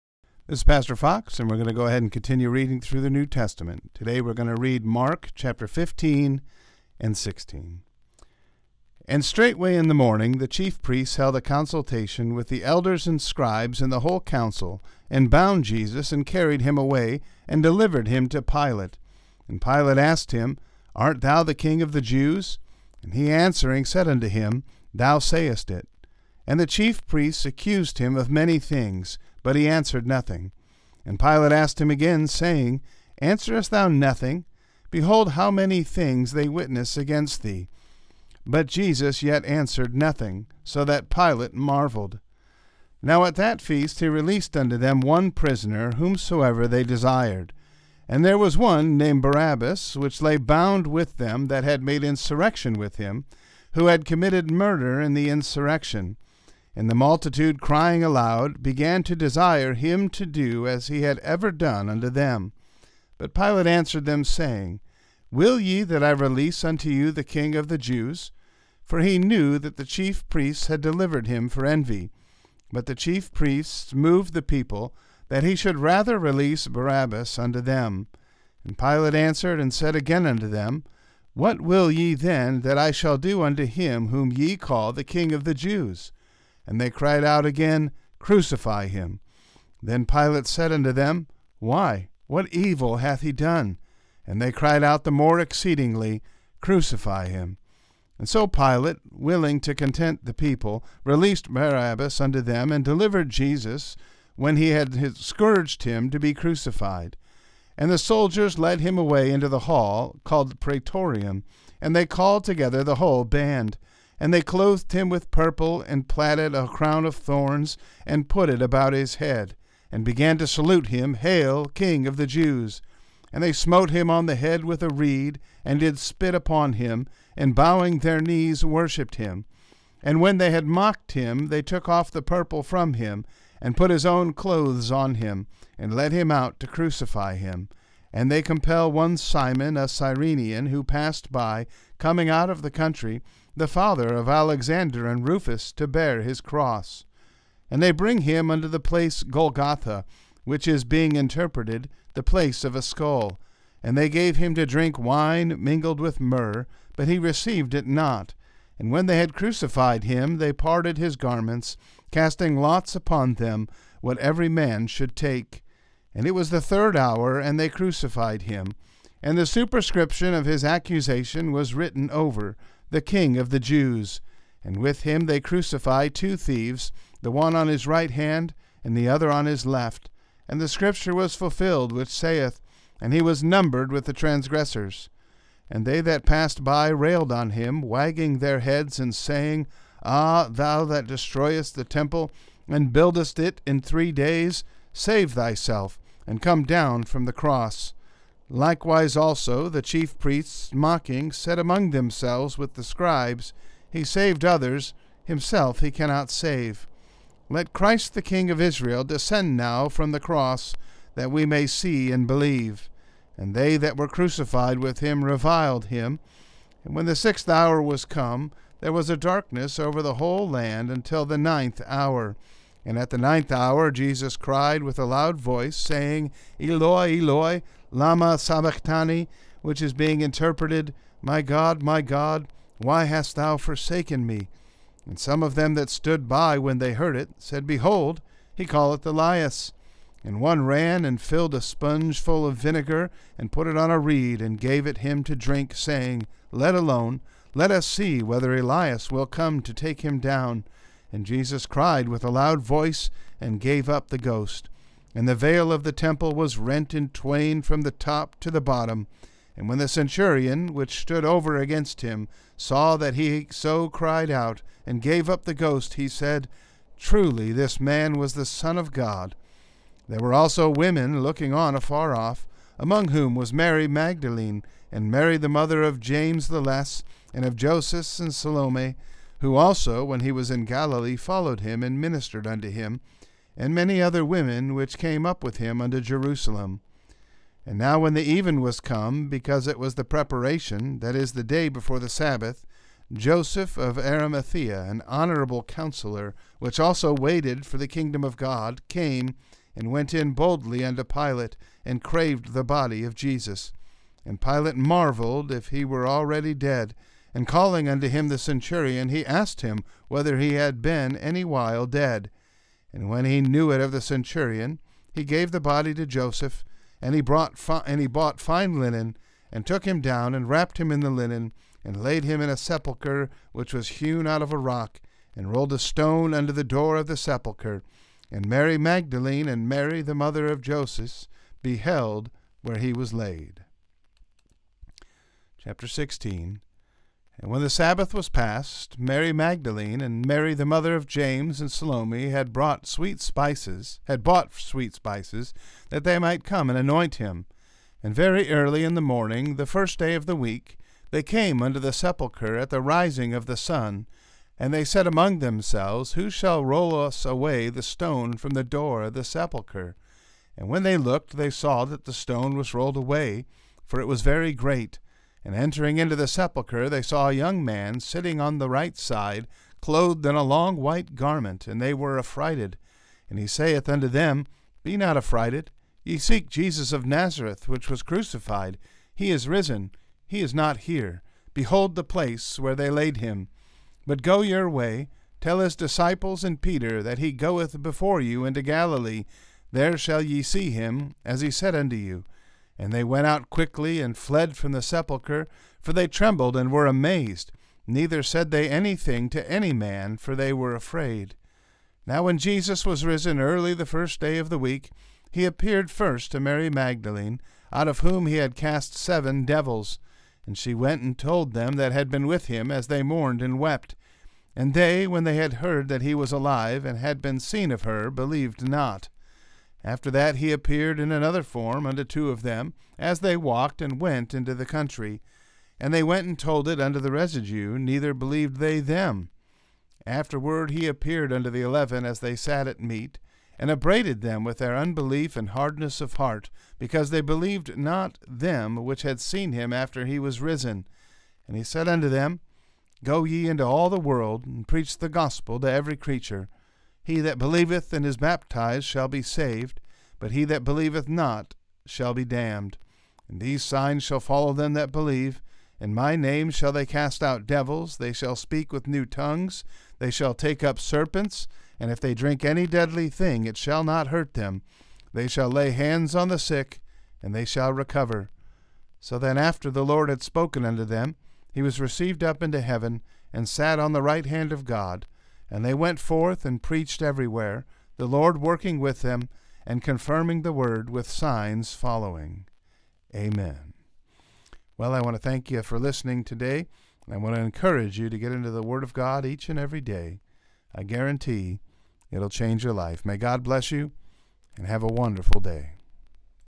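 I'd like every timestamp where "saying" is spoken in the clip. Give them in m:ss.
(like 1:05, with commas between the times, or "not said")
0:32, 1:04, 3:09, 3:45, 4:05.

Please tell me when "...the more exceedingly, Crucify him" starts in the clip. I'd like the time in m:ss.
1:35.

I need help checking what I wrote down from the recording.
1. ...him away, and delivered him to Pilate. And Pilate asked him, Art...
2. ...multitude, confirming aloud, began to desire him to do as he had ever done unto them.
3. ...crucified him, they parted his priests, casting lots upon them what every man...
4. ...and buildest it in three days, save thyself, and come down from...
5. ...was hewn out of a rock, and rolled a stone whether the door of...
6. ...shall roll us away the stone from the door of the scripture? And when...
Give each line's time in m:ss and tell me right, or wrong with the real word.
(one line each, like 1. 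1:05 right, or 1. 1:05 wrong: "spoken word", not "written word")
1. 0:16 right
2. 0:56 wrong: "crying", not "confirming"
3. 2:39 wrong: "garments", not "priests"
4. 3:12 right
5. 5:23 wrong: "under", not "whether"
6. 5:56 wrong: "sepulchre", not "scripture".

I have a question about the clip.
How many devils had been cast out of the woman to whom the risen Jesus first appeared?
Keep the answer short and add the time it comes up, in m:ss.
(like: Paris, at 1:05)
7, at 6:48.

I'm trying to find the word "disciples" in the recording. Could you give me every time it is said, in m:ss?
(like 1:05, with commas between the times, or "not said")
6:25.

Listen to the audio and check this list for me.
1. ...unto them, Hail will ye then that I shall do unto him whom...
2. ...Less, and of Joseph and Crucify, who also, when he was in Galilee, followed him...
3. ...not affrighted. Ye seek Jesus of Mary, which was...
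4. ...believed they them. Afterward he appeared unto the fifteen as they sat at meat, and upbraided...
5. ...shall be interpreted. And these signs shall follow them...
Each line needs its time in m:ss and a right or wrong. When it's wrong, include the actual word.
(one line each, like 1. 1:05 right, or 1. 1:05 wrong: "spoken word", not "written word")
1. 1:20 wrong: "What", not "Hail"
2. 4:36 wrong: "Salome", not "Crucify"
3. 6:14 wrong: "Nazareth", not "Mary"
4. 7:08 wrong: "eleven", not "fifteen"
5. 7:31 wrong: "damned", not "interpreted".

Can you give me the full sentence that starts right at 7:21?
And he said unto them, Go ye into all the world, and preach the gospel to every creature.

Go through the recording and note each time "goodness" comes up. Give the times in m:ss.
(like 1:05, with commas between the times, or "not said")
not said.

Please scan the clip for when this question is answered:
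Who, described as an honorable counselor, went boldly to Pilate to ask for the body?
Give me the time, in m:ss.
4:53.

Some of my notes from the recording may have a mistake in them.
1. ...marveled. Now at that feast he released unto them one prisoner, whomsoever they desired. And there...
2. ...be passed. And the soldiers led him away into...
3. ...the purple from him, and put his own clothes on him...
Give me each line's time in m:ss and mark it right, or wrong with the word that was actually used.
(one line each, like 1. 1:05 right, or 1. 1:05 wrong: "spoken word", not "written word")
1. 0:41 right
2. 1:46 wrong: "crucified", not "passed"
3. 2:12 right.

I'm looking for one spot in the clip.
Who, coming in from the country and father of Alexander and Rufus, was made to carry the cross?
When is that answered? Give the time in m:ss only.
2:19.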